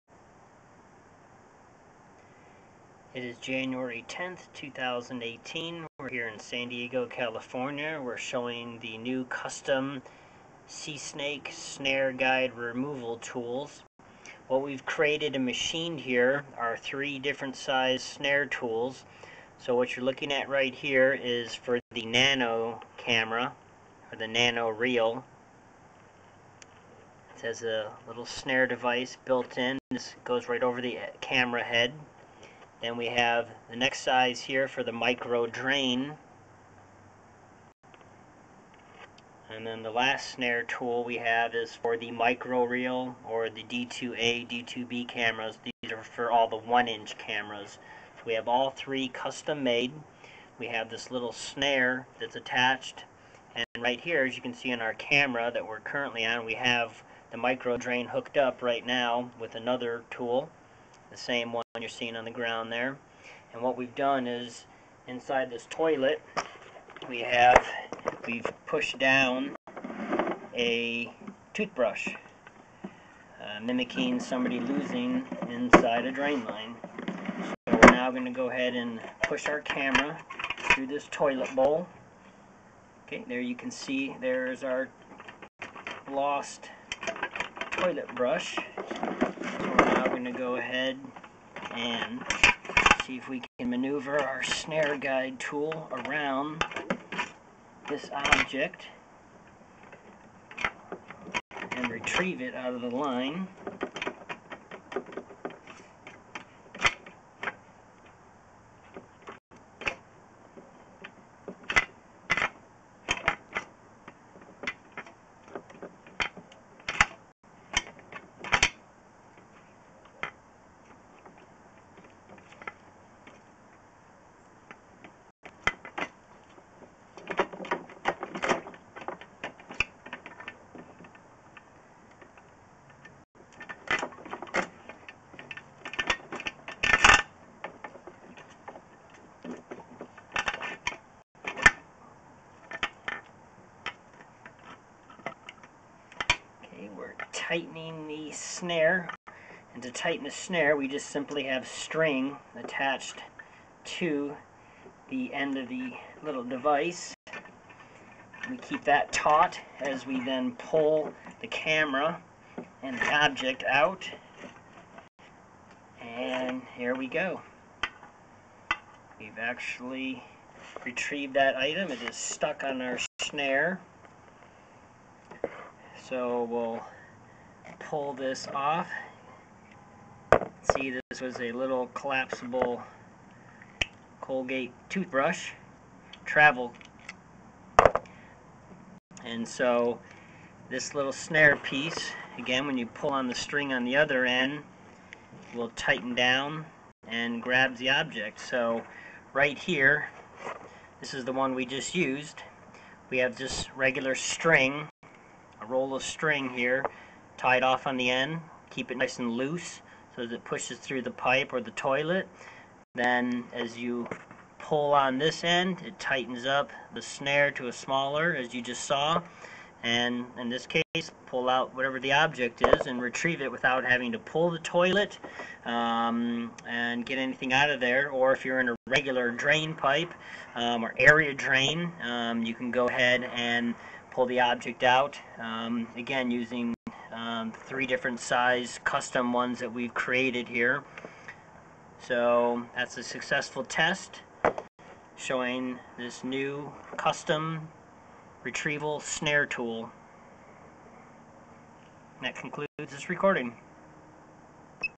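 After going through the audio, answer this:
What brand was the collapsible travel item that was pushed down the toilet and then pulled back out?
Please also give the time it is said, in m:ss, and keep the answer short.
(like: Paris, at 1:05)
Colgate, at 3:04.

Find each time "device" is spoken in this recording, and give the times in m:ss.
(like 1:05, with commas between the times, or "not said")
0:28, 2:36.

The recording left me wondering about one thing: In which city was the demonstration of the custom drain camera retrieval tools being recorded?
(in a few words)
San Diego.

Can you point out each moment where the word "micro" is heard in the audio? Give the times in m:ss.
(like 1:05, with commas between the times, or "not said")
0:34, 0:42, 0:57.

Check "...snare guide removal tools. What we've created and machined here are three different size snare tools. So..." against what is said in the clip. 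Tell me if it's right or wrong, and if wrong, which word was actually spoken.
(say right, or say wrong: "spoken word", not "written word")
right.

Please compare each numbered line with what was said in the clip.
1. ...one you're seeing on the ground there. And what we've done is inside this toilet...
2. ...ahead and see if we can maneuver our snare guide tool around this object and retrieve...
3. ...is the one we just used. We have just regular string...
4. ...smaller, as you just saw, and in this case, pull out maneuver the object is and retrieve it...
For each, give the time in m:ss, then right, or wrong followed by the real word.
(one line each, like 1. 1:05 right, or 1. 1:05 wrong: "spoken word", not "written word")
1. 1:01 right
2. 1:30 right
3. 3:21 right
4. 3:37 wrong: "whatever", not "maneuver".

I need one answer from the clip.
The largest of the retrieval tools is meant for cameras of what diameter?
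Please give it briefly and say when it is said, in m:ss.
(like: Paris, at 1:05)
1 inch, at 0:46.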